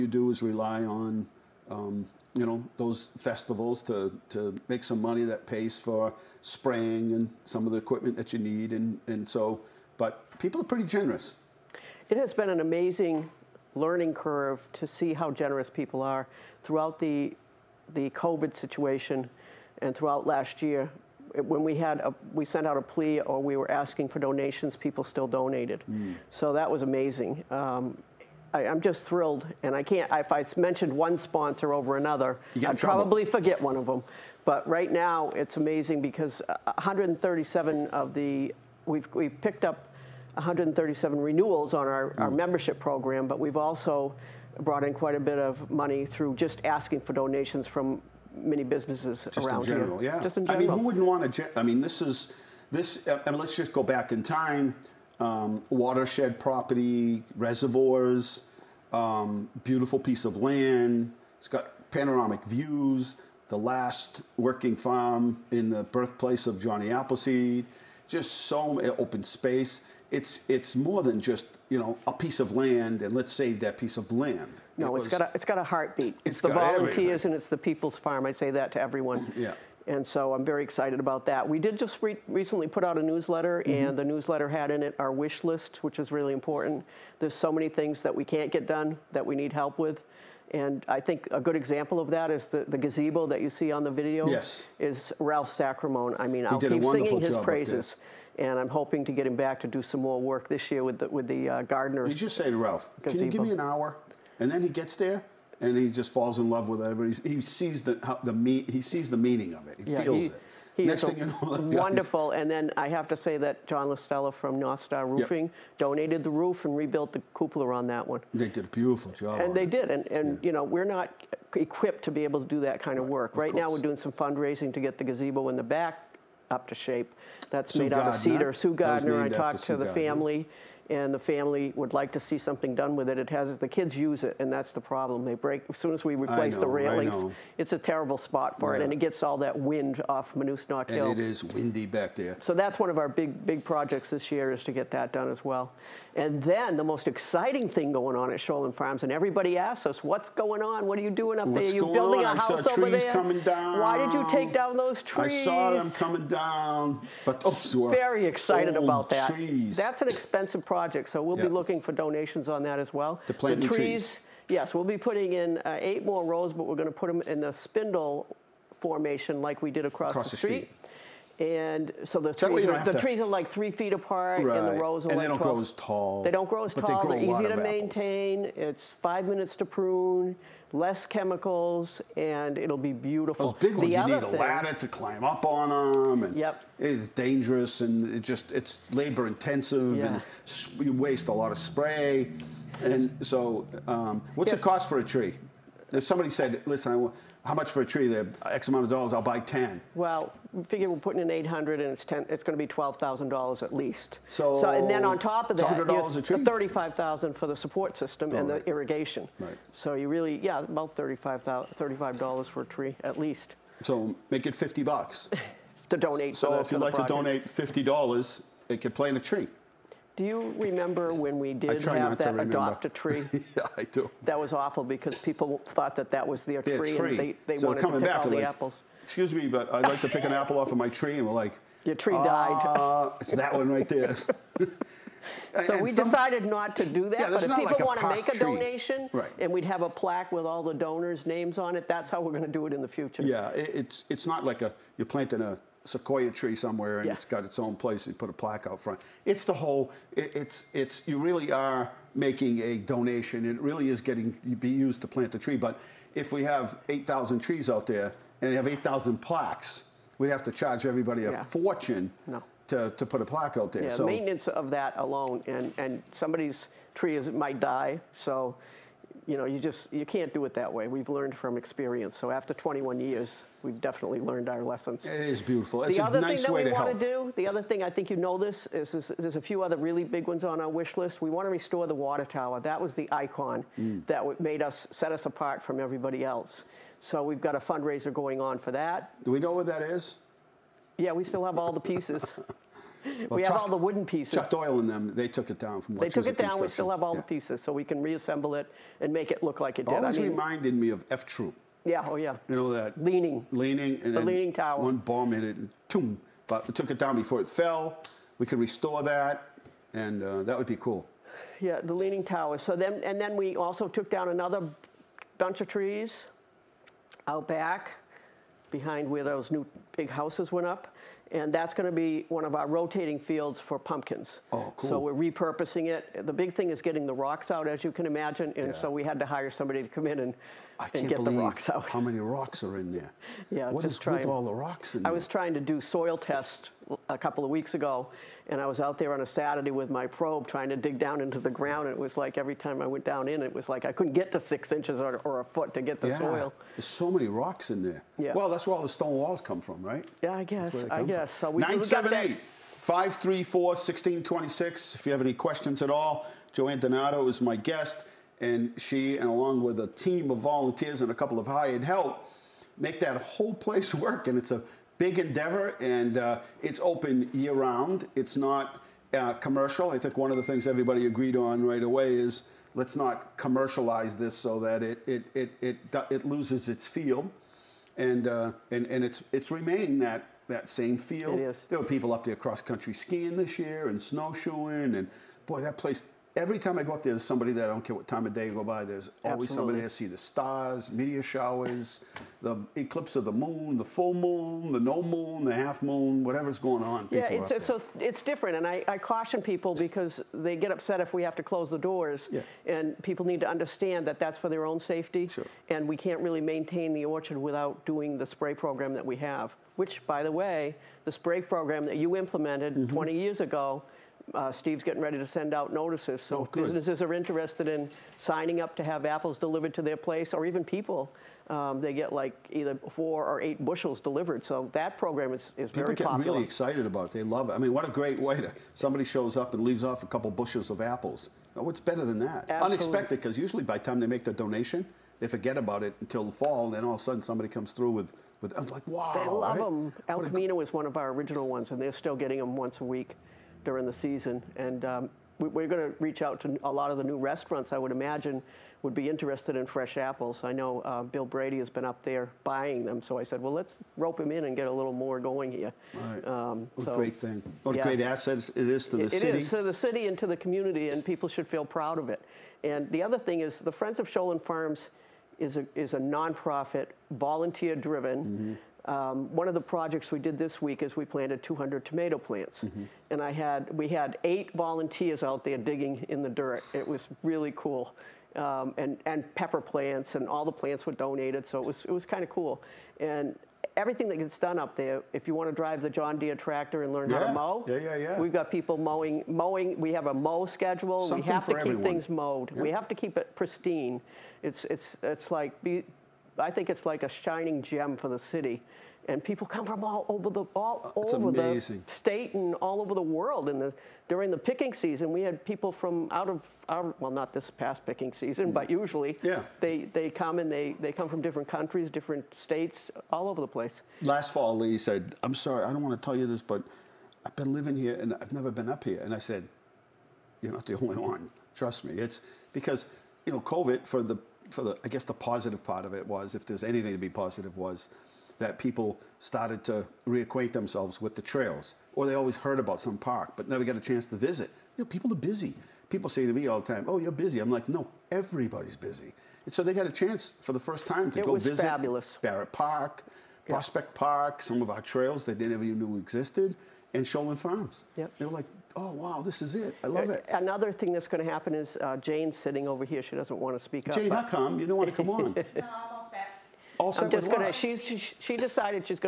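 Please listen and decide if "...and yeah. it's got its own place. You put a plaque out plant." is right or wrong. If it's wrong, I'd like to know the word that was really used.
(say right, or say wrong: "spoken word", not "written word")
wrong: "front", not "plant".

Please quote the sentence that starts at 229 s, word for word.
Excuse me, but I'd like to pick an apple off of my tree, and we're like, Your tree died.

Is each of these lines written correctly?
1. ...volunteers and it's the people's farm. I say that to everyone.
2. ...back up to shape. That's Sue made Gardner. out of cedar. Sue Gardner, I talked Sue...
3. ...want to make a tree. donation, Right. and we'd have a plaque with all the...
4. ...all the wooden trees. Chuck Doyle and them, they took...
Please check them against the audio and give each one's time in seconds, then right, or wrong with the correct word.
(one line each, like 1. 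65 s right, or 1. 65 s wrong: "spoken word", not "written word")
1. 76 s right
2. 125 s right
3. 237 s right
4. 293 s wrong: "pieces", not "trees".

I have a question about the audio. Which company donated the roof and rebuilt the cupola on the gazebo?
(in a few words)
North Roofing.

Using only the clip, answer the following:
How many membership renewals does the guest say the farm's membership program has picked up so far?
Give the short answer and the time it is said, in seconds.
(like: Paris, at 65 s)
137, at 40 s.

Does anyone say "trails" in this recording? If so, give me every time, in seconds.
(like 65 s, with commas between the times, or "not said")
531 s, 544 s.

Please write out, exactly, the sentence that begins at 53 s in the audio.
I mean, let's just go back in time.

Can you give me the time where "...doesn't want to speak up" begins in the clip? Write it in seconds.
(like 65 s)
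553 s.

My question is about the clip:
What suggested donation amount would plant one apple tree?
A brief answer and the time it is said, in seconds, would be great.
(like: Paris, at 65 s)
$50, at 214 s.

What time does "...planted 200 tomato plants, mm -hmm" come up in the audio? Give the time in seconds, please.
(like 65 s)
471 s.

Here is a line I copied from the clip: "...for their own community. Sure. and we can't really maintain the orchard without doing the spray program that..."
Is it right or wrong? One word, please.
wrong.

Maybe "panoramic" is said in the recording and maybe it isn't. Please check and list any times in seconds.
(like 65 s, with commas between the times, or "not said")
61 s.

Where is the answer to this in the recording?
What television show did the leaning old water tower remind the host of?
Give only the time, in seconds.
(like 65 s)
301 s.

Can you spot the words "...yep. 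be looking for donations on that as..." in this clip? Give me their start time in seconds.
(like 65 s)
161 s.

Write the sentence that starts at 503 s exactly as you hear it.
And the, during the picking season, we had people from out of our, well, not this past picking season, but mm.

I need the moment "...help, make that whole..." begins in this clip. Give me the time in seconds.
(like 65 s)
361 s.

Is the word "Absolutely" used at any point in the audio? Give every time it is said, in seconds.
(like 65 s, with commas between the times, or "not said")
389 s, 432 s.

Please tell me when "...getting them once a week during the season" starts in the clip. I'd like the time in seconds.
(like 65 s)
442 s.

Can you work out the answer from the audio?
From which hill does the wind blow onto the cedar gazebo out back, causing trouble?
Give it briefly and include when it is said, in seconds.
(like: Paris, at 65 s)
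Monoosnoc Hill, at 140 s.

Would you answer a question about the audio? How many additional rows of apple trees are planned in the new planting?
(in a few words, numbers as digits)
8.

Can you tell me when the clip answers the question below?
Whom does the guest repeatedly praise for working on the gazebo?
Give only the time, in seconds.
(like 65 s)
95 s.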